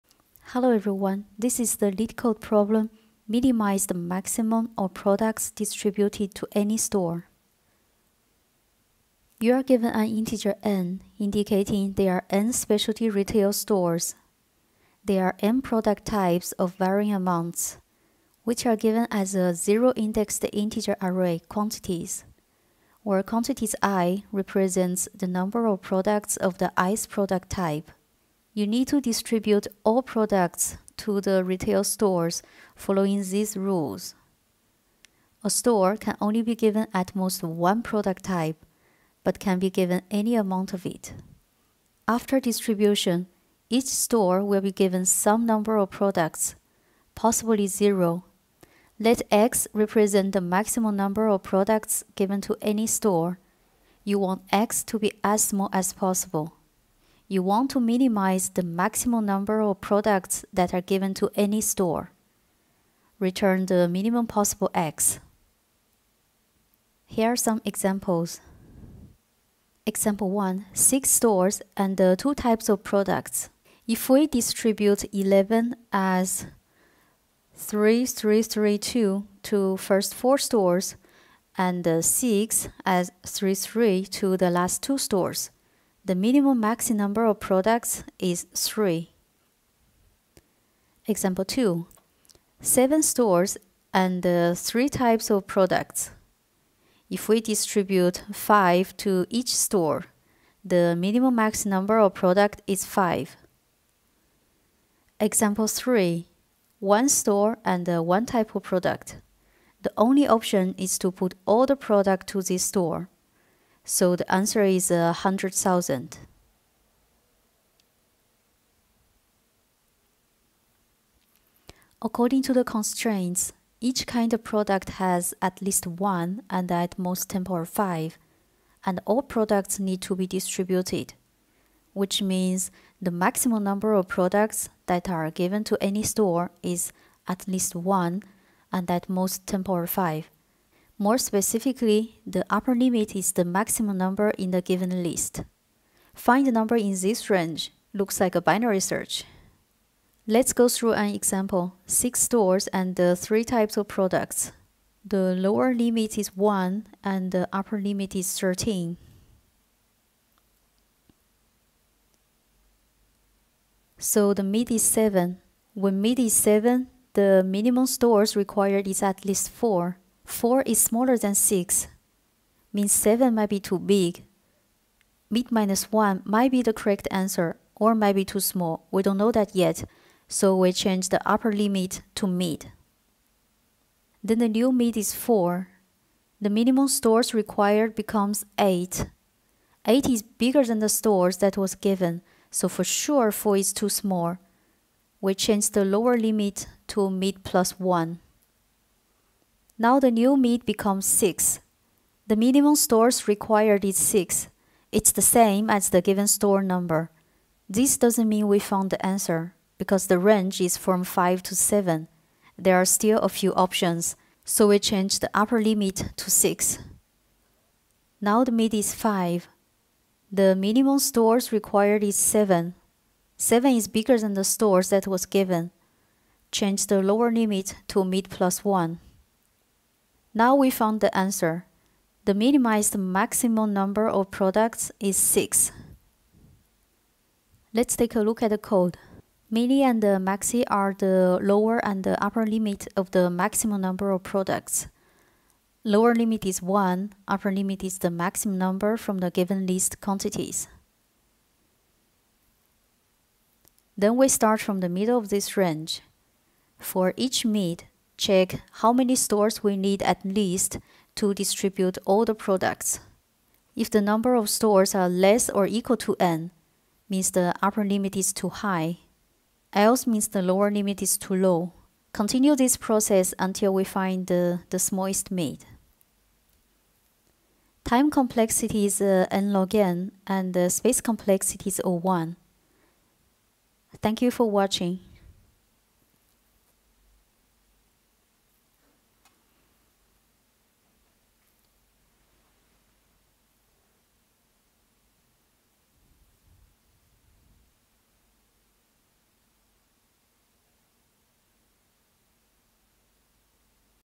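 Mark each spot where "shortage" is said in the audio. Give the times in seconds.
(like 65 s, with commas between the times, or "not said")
not said.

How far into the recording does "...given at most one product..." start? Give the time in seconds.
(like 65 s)
36 s.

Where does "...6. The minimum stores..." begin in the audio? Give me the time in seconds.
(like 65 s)
201 s.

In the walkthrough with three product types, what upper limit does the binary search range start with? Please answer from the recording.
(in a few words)
13.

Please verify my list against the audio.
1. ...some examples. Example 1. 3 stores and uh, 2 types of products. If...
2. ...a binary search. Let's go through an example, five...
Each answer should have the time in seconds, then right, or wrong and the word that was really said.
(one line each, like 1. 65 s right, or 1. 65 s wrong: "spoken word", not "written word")
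1. 67 s wrong: "6", not "3"
2. 148 s wrong: "six", not "five".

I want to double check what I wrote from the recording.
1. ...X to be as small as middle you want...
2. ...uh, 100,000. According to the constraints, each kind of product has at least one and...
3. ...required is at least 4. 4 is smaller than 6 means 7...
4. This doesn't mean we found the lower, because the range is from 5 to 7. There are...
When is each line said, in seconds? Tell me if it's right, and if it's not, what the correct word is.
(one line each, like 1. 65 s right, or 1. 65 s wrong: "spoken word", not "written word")
1. 54 s wrong: "possible", not "middle"
2. 114 s right
3. 168 s right
4. 207 s wrong: "answer", not "lower".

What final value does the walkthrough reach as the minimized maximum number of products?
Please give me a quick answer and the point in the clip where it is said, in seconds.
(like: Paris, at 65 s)
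6, at 232 s.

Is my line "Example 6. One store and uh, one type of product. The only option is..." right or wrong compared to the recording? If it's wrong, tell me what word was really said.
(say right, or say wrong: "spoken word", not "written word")
wrong: "3", not "6".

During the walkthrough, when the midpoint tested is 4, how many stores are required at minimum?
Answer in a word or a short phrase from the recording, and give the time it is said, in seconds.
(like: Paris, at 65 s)
8, at 186 s.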